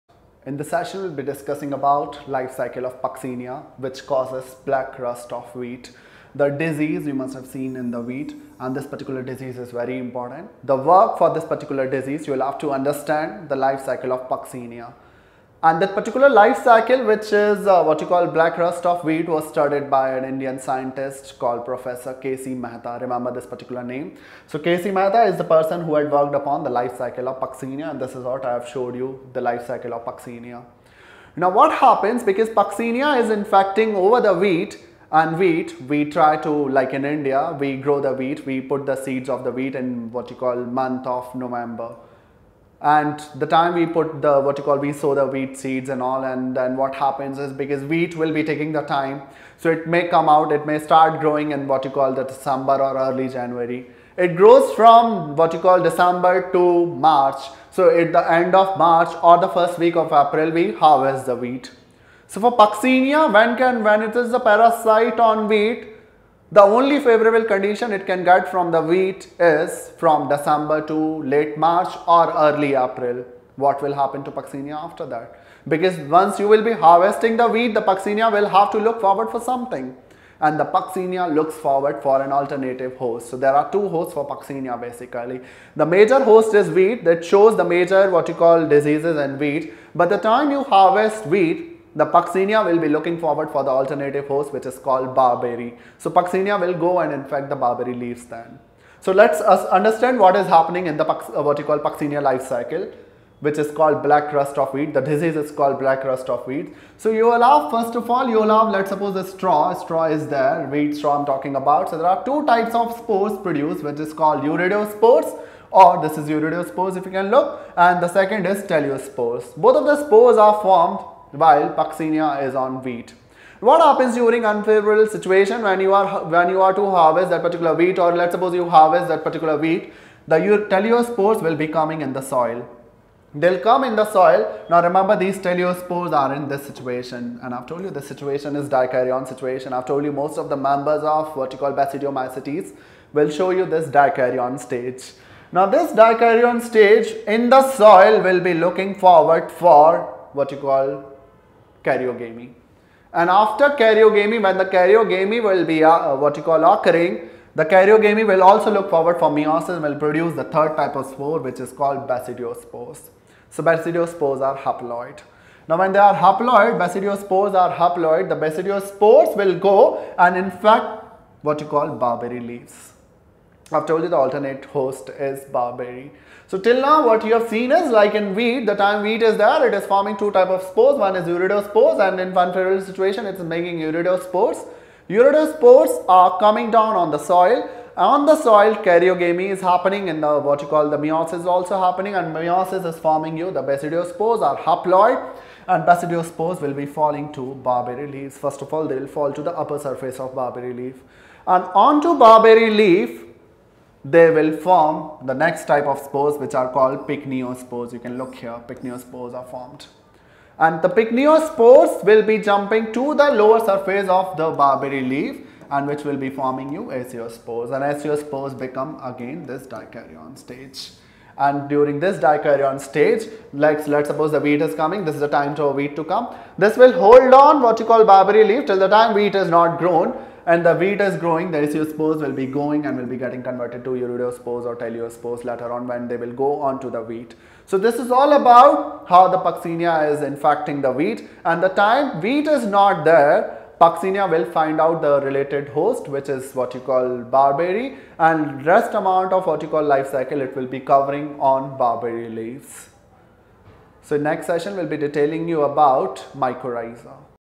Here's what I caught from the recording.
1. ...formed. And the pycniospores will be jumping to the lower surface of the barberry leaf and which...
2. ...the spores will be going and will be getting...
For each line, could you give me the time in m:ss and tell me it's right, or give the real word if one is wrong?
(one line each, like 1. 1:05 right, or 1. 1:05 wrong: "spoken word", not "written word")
1. 3:29 right
2. 3:51 right.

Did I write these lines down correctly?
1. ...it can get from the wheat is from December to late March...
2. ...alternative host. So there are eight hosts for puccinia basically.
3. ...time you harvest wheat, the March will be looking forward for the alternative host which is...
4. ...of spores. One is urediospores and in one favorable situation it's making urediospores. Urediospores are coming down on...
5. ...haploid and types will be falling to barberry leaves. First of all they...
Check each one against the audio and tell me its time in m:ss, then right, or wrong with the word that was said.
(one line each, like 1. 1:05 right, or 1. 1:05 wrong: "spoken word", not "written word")
1. 1:07 right
2. 1:22 wrong: "two", not "eight"
3. 1:30 wrong: "Puccinia", not "March"
4. 3:00 right
5. 3:14 wrong: "basidiospores", not "types".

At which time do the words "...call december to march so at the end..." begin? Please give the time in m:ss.
0:55.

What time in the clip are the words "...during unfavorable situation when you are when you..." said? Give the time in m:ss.
2:04.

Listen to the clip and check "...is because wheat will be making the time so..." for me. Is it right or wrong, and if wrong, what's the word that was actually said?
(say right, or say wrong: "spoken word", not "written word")
wrong: "taking", not "making".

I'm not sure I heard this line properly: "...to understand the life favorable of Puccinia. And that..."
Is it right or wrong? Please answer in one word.
wrong.